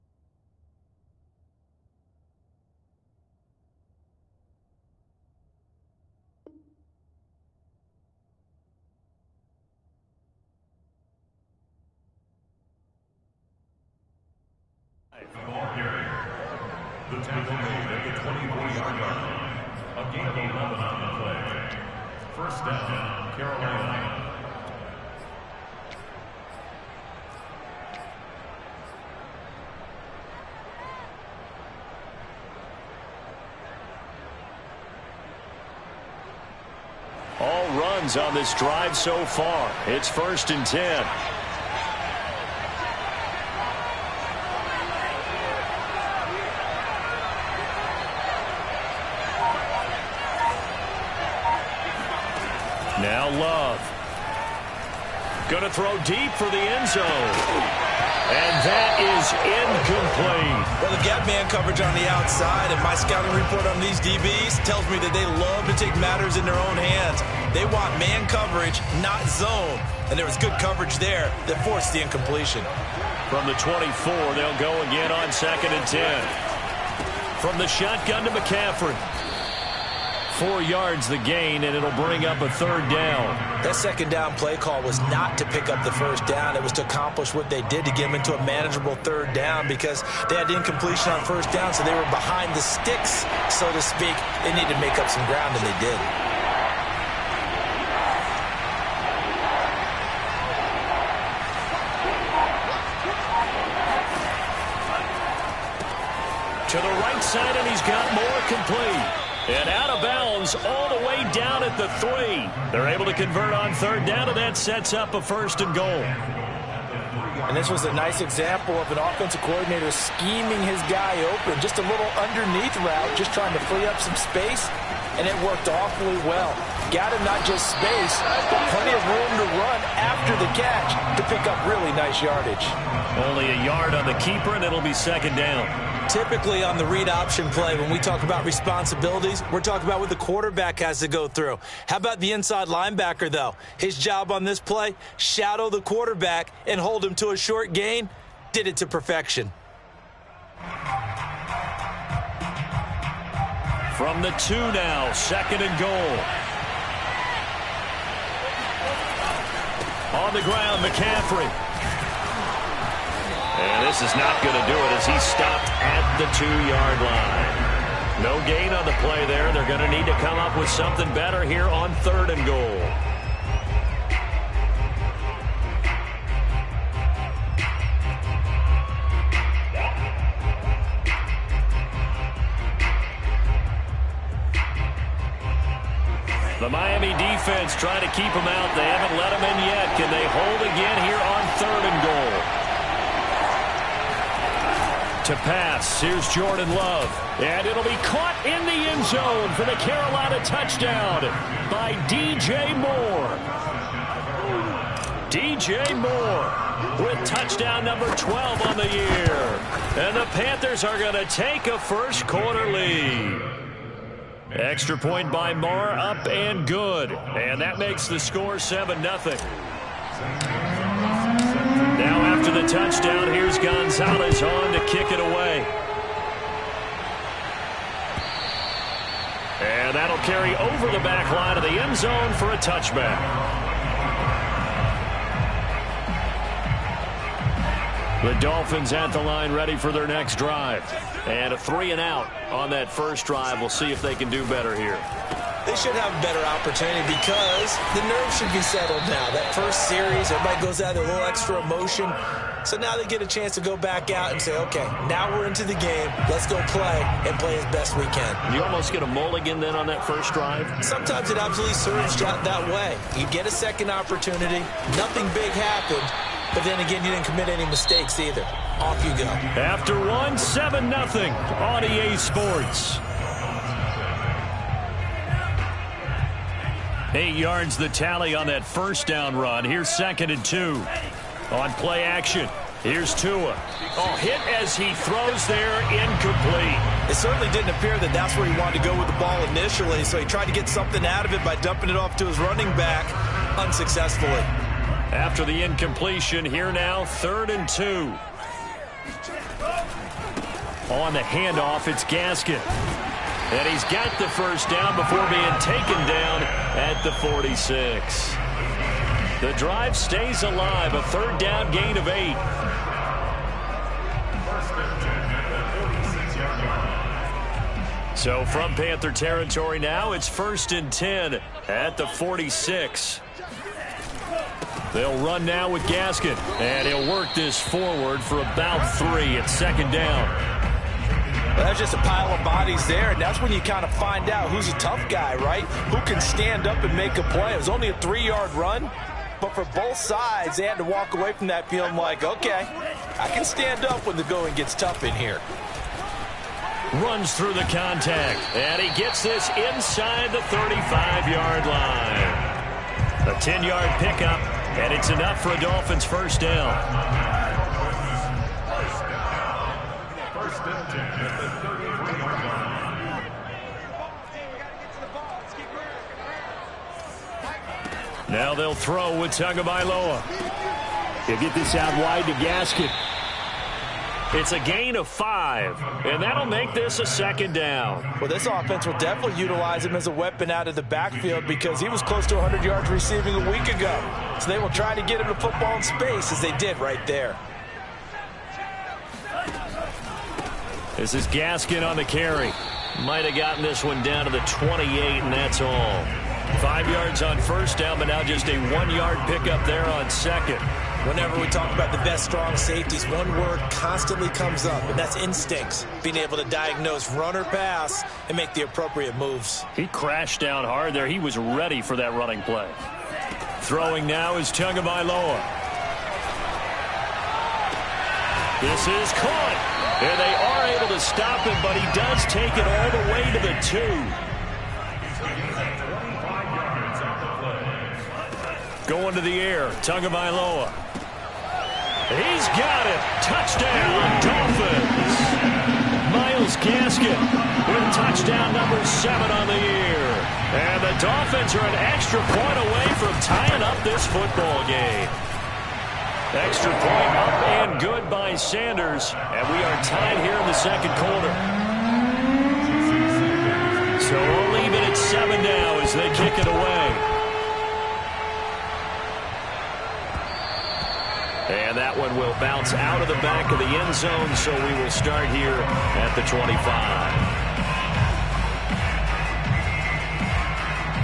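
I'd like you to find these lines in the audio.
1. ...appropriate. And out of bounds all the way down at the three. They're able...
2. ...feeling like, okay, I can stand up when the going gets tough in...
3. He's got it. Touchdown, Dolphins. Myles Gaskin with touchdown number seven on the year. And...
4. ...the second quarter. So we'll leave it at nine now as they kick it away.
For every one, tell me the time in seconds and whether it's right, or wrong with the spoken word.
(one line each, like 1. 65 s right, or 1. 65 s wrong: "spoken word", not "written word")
1. 108 s wrong: "complete", not "appropriate"
2. 341 s right
3. 432 s right
4. 450 s wrong: "seven", not "nine".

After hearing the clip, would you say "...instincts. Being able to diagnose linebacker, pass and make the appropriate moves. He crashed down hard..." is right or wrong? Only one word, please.
wrong.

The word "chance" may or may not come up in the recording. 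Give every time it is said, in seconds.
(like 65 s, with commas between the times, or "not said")
253 s.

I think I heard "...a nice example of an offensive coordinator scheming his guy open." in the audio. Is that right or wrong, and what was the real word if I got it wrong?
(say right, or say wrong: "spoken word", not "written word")
right.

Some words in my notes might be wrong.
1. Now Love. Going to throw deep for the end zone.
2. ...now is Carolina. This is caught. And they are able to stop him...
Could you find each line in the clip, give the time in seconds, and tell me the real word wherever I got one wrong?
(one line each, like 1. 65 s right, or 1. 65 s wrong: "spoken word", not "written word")
1. 53 s right
2. 414 s wrong: "Tagovailoa", not "Carolina".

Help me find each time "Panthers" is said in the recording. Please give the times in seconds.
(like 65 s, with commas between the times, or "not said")
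210 s, 318 s.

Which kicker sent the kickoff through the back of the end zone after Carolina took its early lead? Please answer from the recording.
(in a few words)
Gonzalez.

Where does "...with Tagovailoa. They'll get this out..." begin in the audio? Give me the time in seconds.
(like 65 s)
369 s.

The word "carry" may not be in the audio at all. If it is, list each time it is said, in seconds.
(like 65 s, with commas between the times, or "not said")
230 s, 392 s.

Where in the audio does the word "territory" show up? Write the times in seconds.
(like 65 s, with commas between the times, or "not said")
319 s.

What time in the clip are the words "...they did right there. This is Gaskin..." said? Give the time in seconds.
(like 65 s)
386 s.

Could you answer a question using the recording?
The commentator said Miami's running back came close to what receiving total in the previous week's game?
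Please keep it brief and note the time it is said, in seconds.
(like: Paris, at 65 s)
100 yards, at 382 s.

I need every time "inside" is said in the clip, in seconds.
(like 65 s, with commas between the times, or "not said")
142 s, 349 s.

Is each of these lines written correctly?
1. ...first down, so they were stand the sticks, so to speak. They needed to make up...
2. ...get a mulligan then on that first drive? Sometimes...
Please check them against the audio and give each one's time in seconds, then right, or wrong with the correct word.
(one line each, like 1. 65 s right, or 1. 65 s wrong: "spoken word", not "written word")
1. 91 s wrong: "behind", not "stand"
2. 258 s right.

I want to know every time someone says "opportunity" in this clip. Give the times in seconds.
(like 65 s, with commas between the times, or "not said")
246 s, 263 s.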